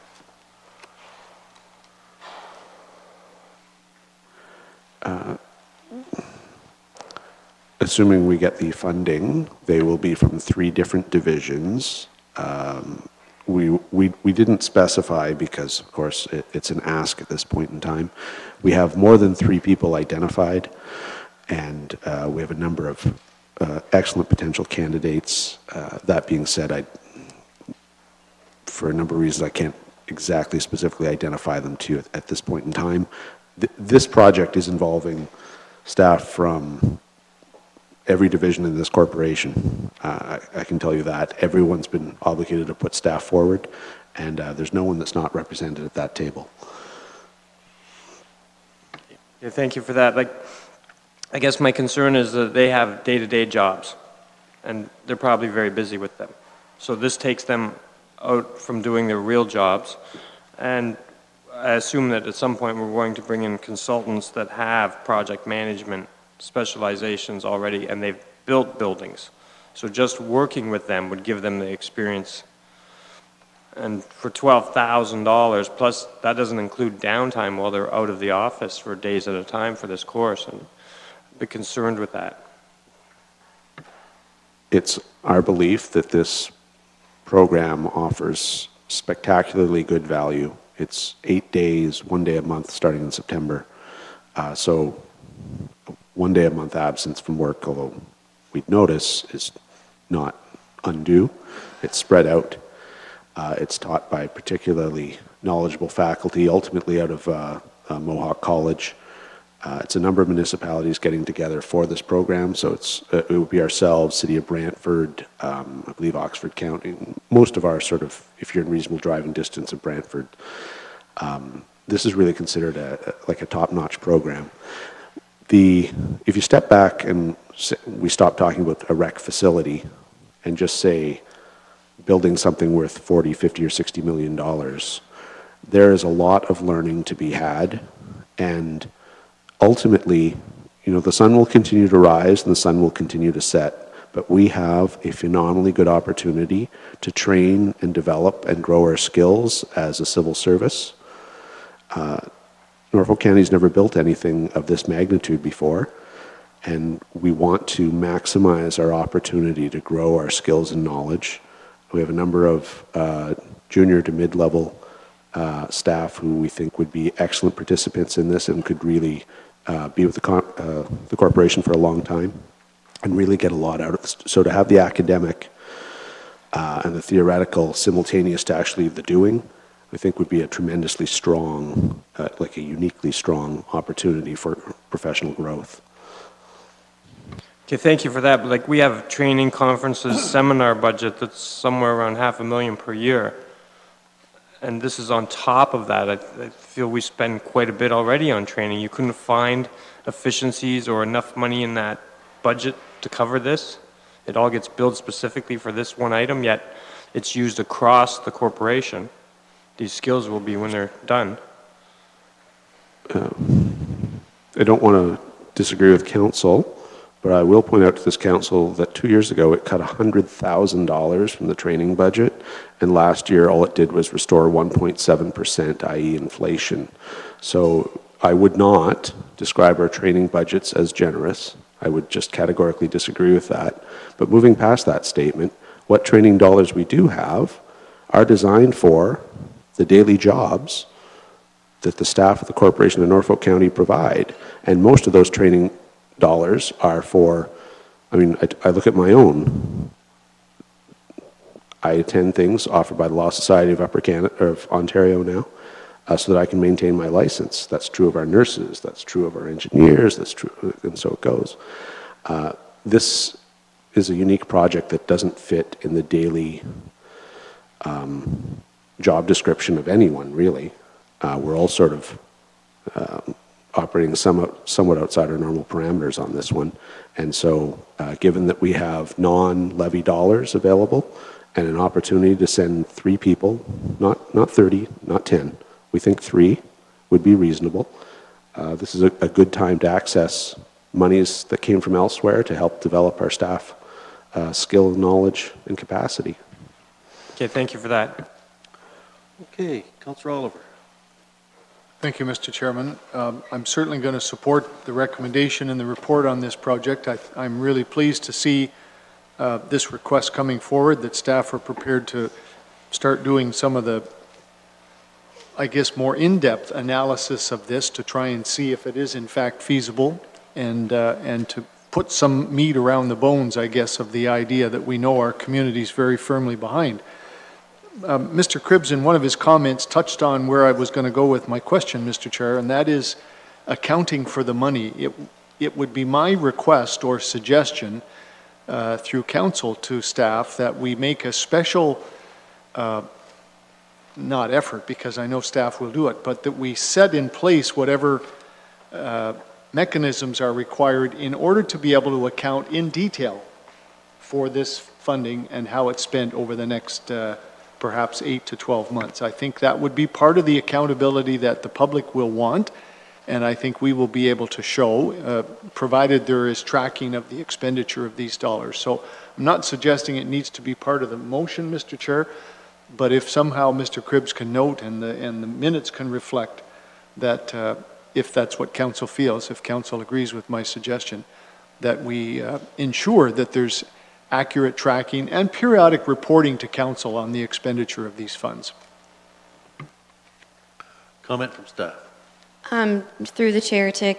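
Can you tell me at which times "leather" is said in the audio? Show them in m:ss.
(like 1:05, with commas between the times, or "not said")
not said.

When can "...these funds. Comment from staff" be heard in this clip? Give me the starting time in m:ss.
6:28.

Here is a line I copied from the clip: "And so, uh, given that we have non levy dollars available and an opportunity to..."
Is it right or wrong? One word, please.
right.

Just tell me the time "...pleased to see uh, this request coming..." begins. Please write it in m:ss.
5:07.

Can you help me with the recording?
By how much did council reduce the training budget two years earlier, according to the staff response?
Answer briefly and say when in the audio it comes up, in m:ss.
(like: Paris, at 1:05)
$100,000, at 3:39.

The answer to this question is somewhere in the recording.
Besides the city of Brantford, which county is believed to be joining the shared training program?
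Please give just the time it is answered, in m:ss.
1:56.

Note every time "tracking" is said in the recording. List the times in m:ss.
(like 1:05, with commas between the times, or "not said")
6:06, 6:24.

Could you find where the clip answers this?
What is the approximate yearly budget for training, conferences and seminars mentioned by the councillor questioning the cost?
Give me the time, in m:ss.
3:12.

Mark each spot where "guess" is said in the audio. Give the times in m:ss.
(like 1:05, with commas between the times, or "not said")
0:51, 5:15, 5:23.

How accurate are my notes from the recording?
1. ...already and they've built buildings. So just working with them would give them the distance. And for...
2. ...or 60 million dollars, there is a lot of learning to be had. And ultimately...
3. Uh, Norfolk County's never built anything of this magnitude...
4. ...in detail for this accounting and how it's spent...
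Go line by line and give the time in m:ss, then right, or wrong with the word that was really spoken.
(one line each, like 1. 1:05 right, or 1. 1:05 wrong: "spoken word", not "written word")
1. 1:07 wrong: "experience", not "distance"
2. 2:13 right
3. 2:31 right
4. 5:52 wrong: "funding", not "accounting".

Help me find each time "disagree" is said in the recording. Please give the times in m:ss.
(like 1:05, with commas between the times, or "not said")
3:35, 3:52.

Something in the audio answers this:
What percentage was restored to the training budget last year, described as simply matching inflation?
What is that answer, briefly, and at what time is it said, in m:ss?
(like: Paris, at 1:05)
1.7%, at 3:44.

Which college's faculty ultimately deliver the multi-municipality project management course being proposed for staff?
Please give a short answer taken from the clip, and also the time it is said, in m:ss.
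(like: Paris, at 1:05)
Mohawk College, at 1:47.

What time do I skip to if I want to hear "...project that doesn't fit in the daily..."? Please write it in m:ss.
4:24.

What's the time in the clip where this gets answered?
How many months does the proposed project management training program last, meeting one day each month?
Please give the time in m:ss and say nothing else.
1:31.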